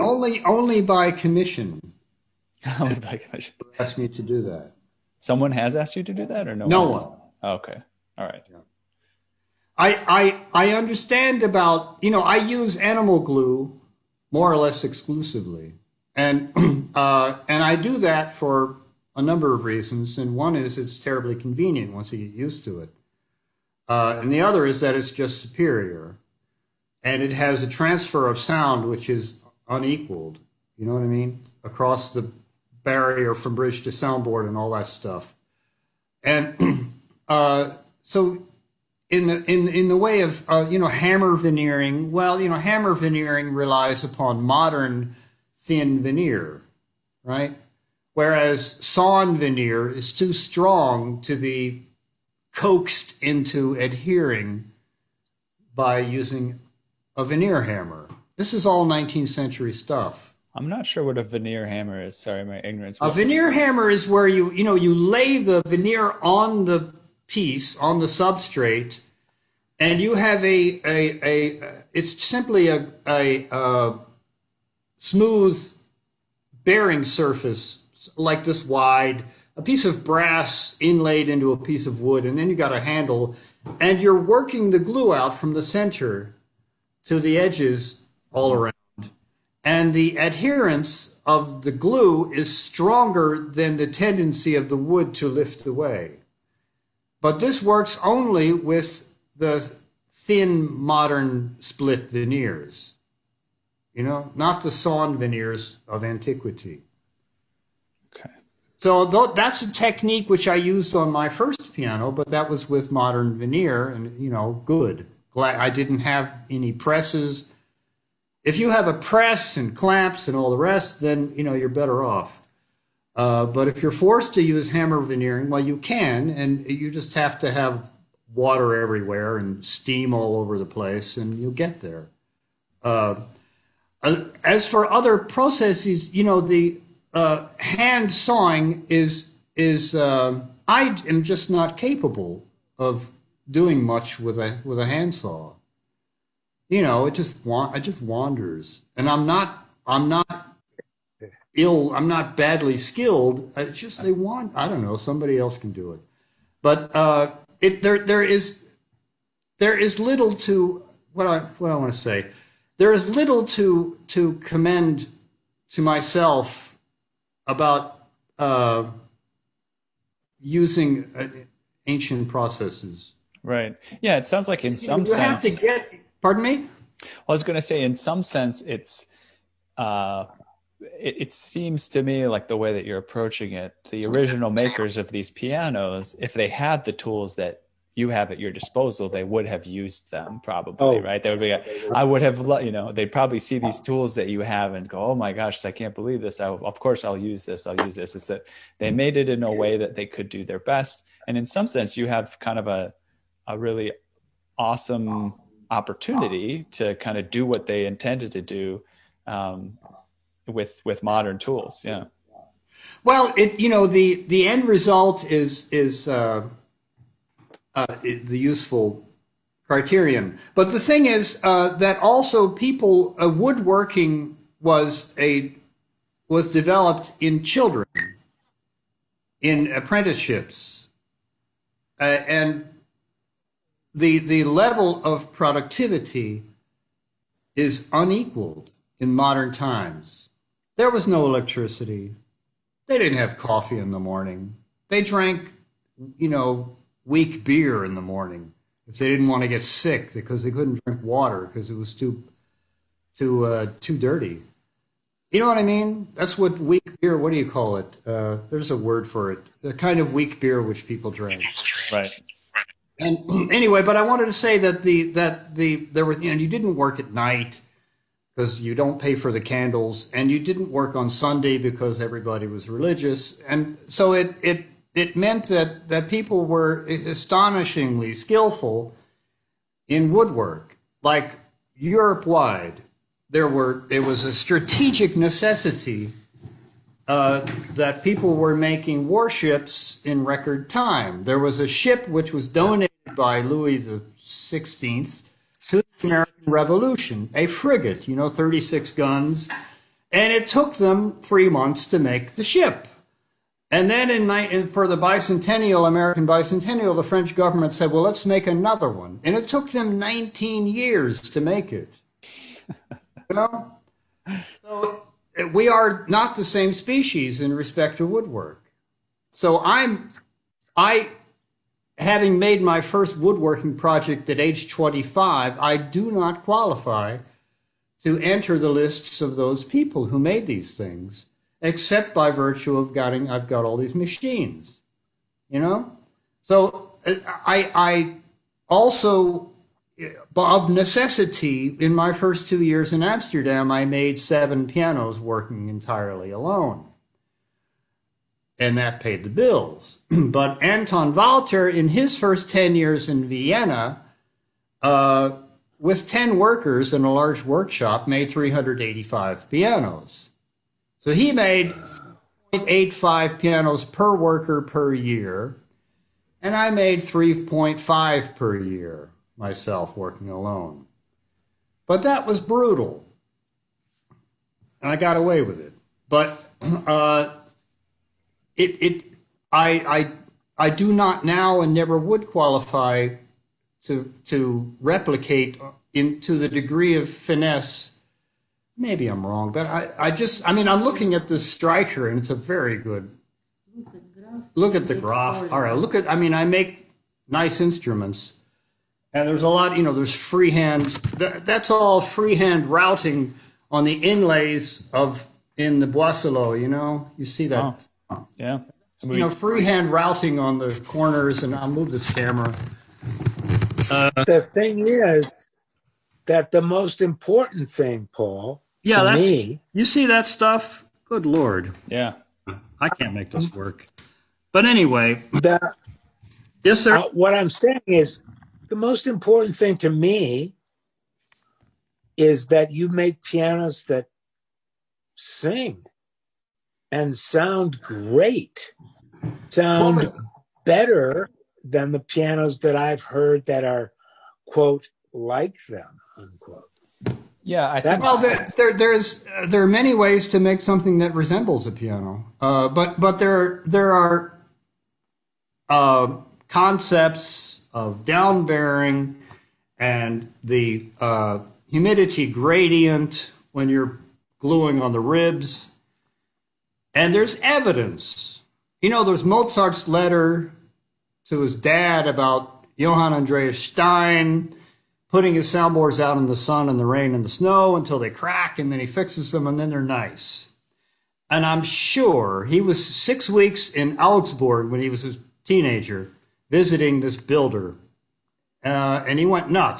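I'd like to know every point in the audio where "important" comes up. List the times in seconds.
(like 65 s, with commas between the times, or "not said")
417 s, 429 s.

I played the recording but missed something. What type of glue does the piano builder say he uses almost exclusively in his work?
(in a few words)
Animal glue.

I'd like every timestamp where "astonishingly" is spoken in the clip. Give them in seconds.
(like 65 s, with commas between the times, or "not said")
276 s.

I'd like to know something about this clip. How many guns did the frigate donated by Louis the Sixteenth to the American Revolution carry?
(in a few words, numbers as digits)
36.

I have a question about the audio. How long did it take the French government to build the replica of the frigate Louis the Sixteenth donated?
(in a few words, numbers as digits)
19 years.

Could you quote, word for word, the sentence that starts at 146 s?
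You know, it just want it just wanders, and I'm not I'm not ill.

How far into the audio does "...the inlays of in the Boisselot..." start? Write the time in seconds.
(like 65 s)
403 s.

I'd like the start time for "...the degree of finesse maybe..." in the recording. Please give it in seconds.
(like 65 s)
386 s.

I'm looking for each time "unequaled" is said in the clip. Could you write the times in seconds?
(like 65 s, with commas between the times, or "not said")
29 s, 237 s.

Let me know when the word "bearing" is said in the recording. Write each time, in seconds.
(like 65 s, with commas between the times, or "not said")
76 s, 458 s.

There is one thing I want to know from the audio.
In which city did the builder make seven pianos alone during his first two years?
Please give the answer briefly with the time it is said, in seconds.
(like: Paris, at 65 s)
Amsterdam, at 343 s.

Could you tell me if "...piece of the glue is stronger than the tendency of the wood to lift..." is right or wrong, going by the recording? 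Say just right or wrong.
wrong.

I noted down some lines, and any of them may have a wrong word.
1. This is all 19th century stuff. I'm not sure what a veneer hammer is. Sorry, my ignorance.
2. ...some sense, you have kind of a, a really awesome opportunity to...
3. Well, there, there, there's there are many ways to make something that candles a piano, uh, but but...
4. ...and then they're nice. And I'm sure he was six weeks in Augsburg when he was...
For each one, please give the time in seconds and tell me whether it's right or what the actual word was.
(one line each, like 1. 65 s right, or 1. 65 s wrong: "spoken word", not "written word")
1. 58 s right
2. 201 s right
3. 448 s wrong: "resembles", not "candles"
4. 479 s right.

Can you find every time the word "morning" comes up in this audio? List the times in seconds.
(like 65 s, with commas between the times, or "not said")
243 s, 248 s.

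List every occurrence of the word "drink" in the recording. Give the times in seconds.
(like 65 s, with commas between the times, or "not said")
250 s, 261 s.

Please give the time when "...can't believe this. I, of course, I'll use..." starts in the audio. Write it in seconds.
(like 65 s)
195 s.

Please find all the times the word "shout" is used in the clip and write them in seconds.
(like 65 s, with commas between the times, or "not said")
not said.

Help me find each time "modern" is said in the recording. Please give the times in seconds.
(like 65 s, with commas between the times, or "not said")
44 s, 100 s, 112 s, 211 s, 239 s.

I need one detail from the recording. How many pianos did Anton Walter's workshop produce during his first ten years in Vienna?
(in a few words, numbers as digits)
385.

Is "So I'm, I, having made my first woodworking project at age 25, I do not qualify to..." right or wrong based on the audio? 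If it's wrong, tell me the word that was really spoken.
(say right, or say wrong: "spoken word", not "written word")
right.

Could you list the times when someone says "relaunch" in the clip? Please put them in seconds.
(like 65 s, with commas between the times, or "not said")
not said.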